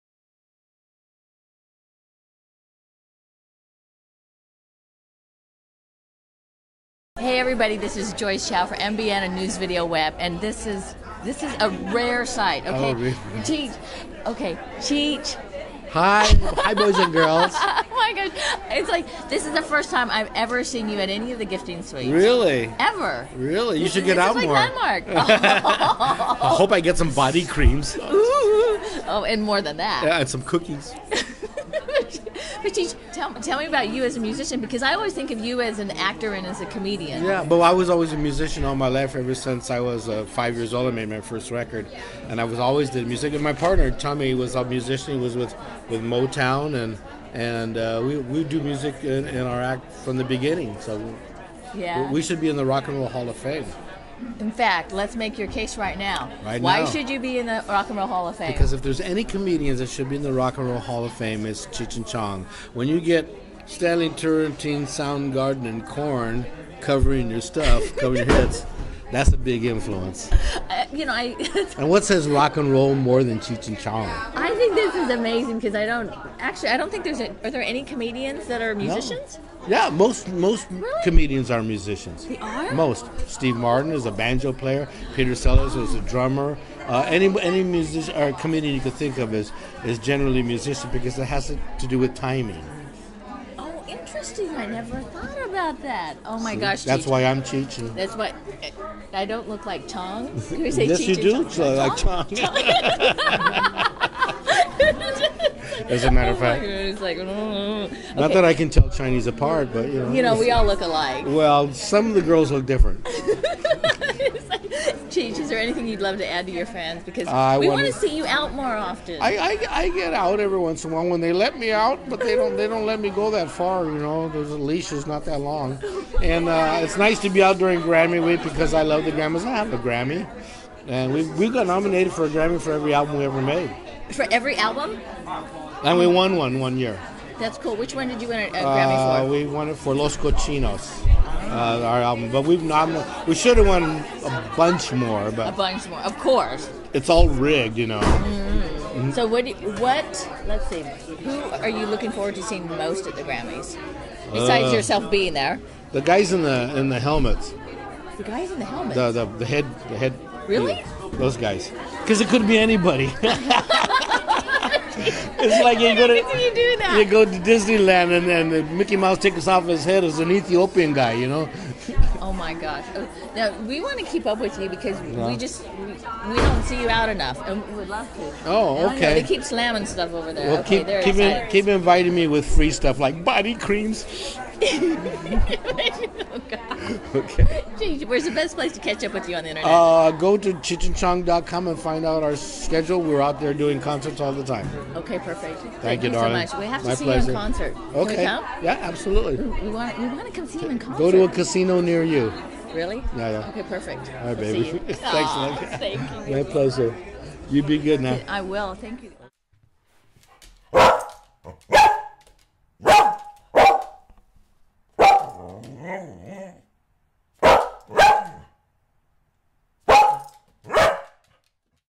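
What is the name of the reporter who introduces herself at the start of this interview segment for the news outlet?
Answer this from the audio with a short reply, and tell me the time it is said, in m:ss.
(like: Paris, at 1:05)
Joyce Chow, at 0:08.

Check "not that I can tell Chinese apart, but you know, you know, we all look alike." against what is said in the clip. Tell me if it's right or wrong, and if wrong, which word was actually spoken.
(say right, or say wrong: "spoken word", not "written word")
right.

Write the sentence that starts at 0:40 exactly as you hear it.
I made my first record, and I was always did music.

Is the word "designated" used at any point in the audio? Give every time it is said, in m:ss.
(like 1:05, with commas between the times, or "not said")
not said.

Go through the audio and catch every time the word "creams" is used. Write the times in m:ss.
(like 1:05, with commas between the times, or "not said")
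0:27, 3:03.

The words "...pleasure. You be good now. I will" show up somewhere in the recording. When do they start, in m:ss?
3:26.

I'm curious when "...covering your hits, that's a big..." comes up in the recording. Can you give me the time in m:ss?
1:07.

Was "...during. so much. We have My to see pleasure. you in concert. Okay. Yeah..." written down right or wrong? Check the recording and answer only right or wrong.
wrong.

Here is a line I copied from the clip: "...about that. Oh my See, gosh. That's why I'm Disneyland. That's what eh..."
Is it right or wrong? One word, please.
wrong.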